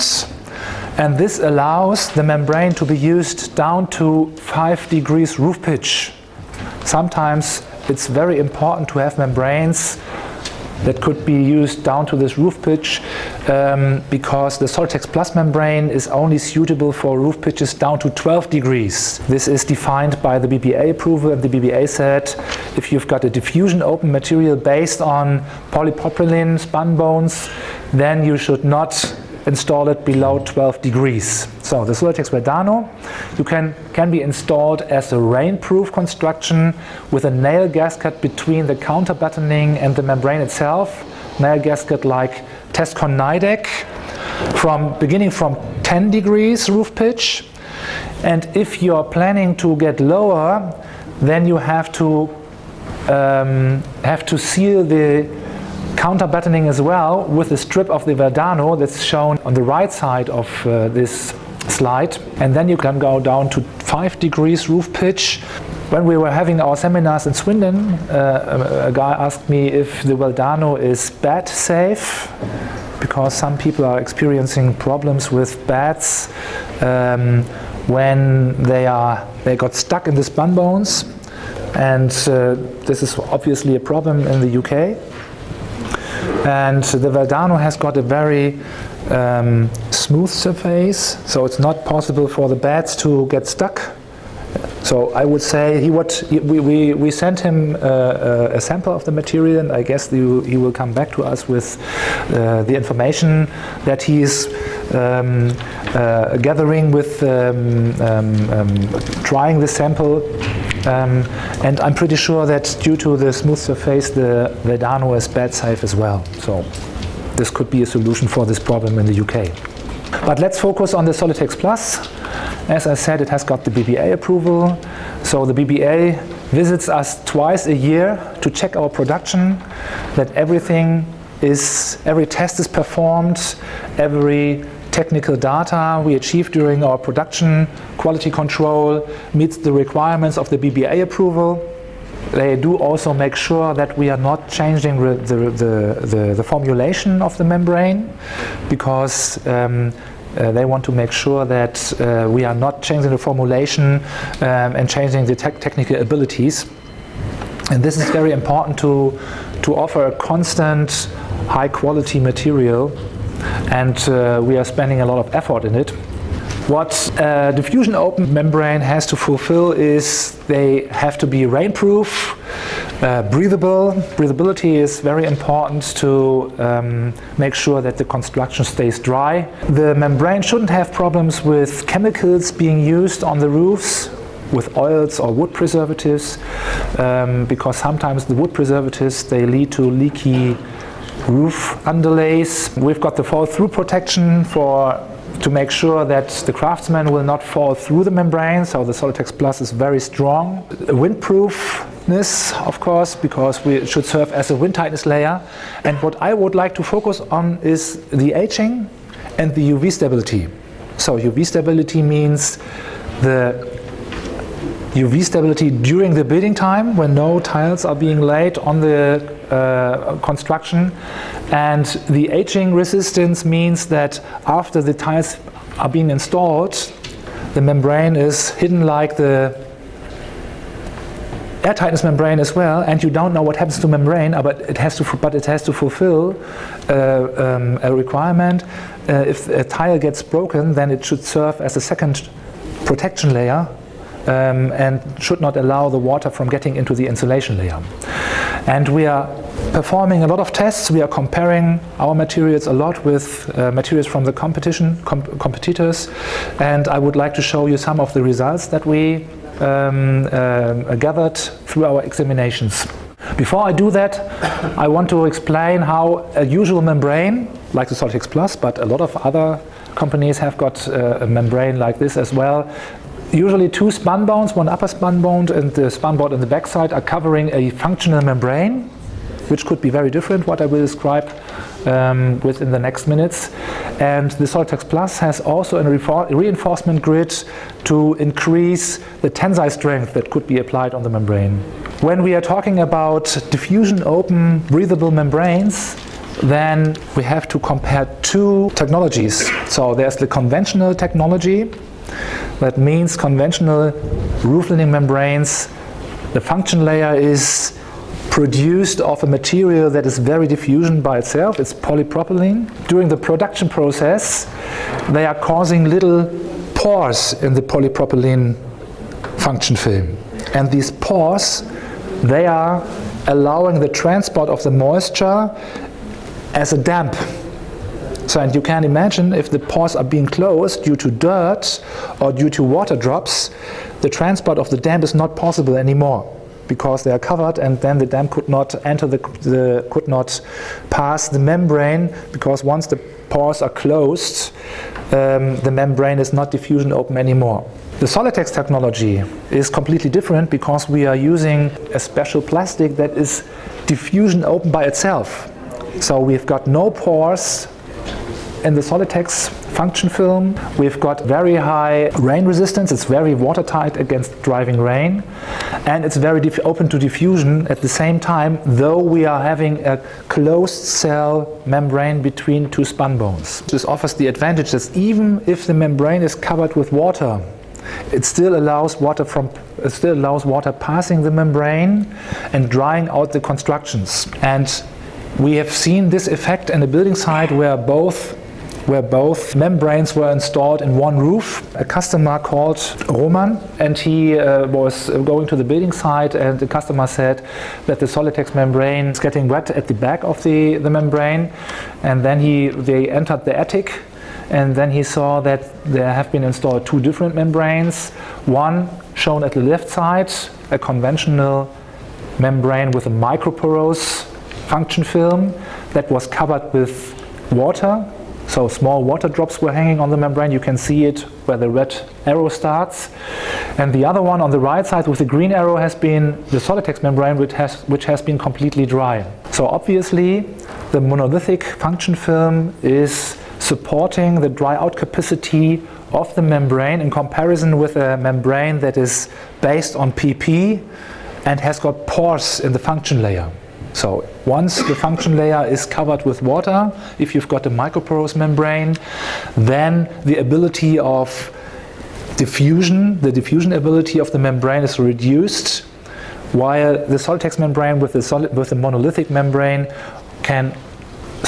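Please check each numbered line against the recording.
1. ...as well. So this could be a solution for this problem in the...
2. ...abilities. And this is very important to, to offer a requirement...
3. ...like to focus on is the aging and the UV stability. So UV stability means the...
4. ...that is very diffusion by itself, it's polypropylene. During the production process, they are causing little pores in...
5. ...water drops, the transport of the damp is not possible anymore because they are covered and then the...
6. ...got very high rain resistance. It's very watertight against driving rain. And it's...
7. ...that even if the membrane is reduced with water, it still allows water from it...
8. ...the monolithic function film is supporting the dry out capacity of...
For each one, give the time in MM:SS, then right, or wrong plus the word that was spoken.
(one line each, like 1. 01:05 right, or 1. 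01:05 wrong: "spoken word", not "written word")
1. 01:55 right
2. 02:35 wrong: "constant", not "requirement"
3. 03:26 right
4. 05:09 right
5. 05:32 right
6. 06:00 right
7. 06:14 wrong: "covered", not "reduced"
8. 07:10 right.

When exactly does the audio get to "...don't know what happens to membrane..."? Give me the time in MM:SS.
03:53.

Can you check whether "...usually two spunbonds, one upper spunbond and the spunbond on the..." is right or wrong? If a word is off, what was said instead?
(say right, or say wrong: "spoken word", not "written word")
right.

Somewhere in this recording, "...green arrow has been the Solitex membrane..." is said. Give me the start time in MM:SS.
07:05.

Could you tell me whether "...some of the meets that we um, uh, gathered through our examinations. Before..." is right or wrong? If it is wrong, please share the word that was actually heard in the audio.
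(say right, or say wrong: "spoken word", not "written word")
wrong: "results", not "meets".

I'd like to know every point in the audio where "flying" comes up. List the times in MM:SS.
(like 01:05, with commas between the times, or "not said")
not said.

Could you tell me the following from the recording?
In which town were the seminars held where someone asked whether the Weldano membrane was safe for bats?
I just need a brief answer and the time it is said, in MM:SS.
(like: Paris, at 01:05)
Swindon, at 01:07.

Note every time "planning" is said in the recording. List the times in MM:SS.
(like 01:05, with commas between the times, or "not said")
00:49.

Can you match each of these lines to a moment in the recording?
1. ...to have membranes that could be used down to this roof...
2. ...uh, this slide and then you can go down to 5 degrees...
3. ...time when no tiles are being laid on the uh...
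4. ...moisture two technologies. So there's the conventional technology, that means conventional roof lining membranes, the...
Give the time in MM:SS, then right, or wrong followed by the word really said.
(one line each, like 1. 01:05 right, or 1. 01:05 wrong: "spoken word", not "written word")
1. 00:08 right
2. 01:00 right
3. 03:36 right
4. 04:57 wrong: "compare", not "moisture".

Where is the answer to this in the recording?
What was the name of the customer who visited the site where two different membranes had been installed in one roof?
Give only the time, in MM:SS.
06:33.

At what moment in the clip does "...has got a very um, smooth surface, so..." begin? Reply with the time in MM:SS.
01:27.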